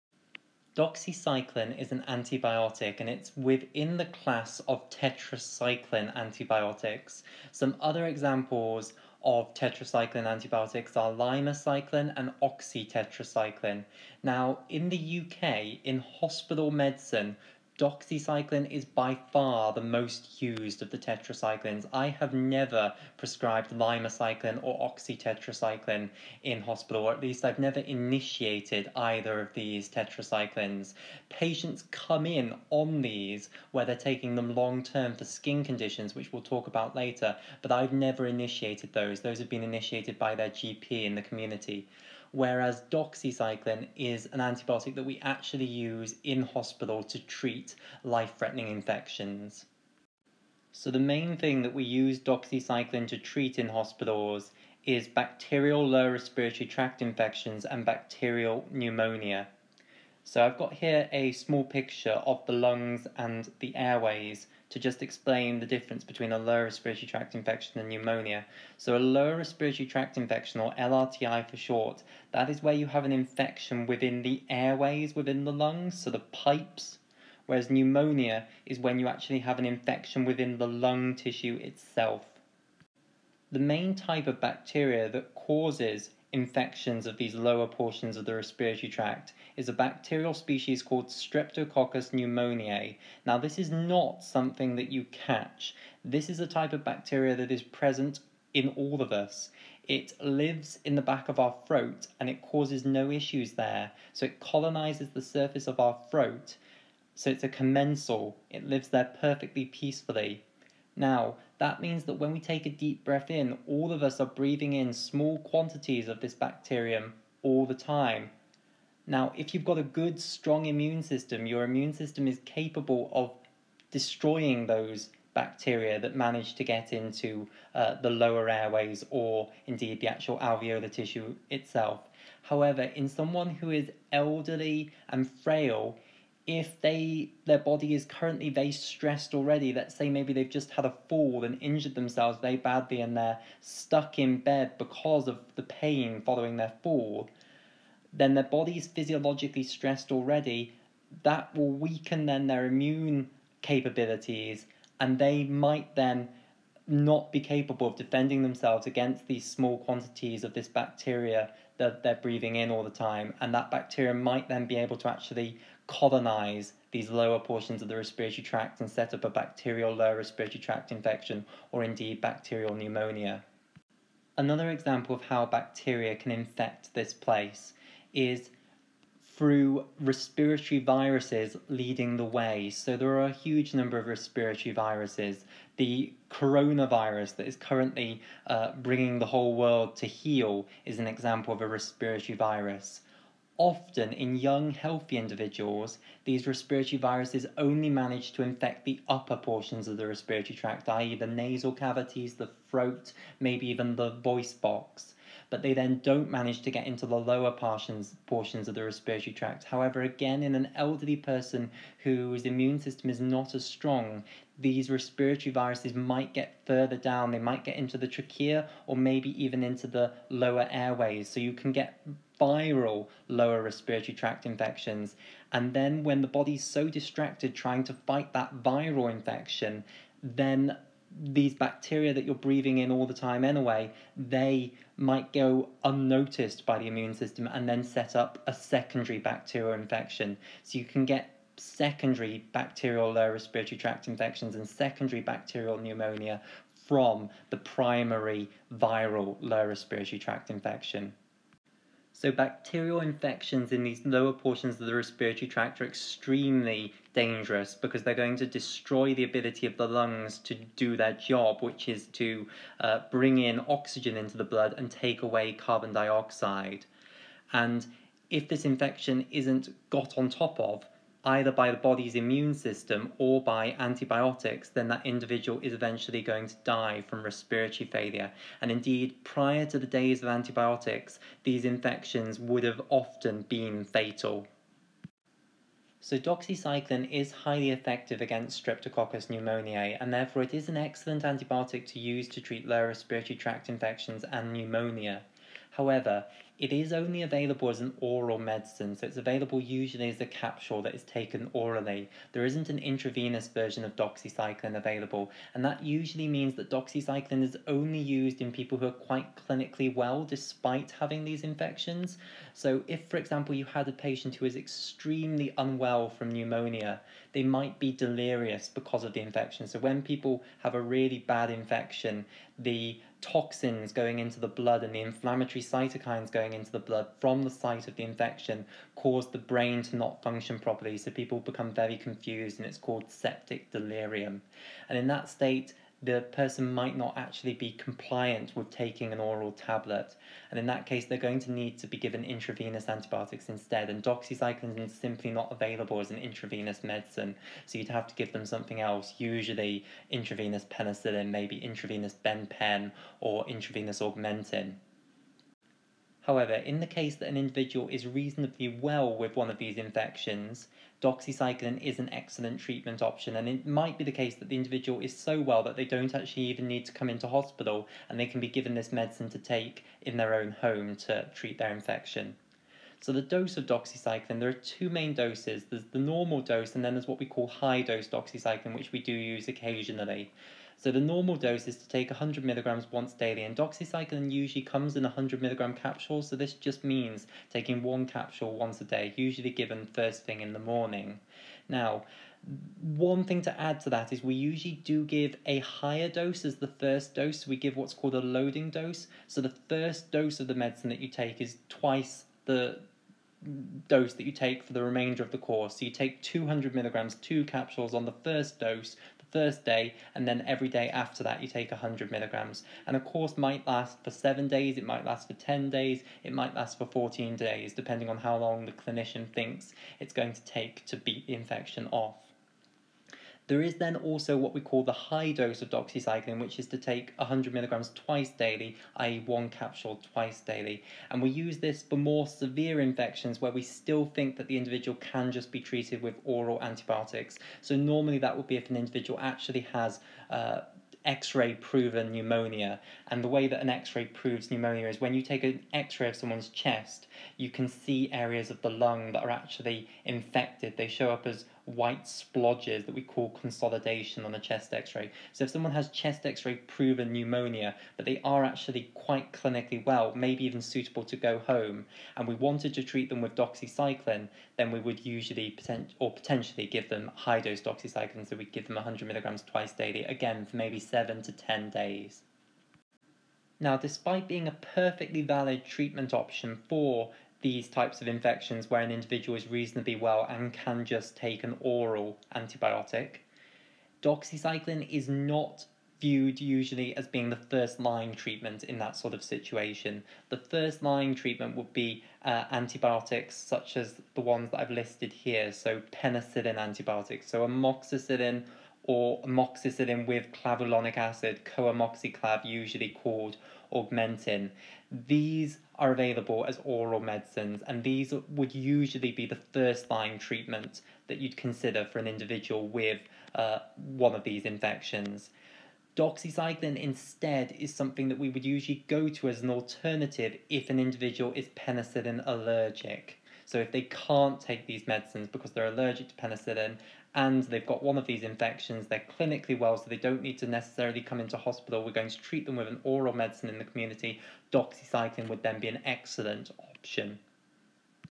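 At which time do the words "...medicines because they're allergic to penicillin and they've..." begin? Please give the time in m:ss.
8:44.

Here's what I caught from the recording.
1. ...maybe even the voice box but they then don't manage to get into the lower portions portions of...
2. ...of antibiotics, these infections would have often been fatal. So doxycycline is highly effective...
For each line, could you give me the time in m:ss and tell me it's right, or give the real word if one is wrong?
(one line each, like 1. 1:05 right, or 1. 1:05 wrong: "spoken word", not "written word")
1. 3:23 right
2. 4:40 right.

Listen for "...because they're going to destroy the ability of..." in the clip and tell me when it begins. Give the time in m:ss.
4:17.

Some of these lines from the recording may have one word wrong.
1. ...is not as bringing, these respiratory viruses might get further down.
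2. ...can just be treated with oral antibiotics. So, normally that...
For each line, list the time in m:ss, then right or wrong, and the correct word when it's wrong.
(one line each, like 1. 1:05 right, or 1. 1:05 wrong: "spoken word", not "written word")
1. 3:33 wrong: "strong", not "bringing"
2. 7:15 right.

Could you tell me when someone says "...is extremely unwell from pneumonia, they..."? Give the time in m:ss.
5:14.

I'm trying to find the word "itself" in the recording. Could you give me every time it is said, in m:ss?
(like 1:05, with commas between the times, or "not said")
1:21, 2:11.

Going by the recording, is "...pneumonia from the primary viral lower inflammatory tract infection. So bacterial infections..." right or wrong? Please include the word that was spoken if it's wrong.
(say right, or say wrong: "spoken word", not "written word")
wrong: "respiratory", not "inflammatory".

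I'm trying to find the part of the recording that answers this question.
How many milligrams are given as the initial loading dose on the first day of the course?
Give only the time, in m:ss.
6:46.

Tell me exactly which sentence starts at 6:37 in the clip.
We give what's called a loading dose.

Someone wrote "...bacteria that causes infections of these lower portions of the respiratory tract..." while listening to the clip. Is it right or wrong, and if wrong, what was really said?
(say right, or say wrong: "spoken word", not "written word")
right.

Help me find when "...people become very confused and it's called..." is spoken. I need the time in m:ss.
5:31.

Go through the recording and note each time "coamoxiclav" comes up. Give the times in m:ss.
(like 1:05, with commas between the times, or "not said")
8:21.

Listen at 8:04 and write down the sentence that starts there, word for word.
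Doxycycline is not viewed usually as being the first line treatment in that sort of situation.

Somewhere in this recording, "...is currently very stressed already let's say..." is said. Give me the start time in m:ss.
2:17.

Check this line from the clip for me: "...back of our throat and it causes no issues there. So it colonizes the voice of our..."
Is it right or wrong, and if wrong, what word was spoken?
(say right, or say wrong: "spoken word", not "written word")
wrong: "surface", not "voice".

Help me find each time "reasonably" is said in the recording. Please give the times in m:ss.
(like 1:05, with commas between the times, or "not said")
5:58, 7:59.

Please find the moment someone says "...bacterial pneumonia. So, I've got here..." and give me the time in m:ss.
0:57.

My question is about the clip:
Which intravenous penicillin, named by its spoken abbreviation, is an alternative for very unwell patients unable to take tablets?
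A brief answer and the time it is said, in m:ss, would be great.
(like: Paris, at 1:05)
benpen, at 5:52.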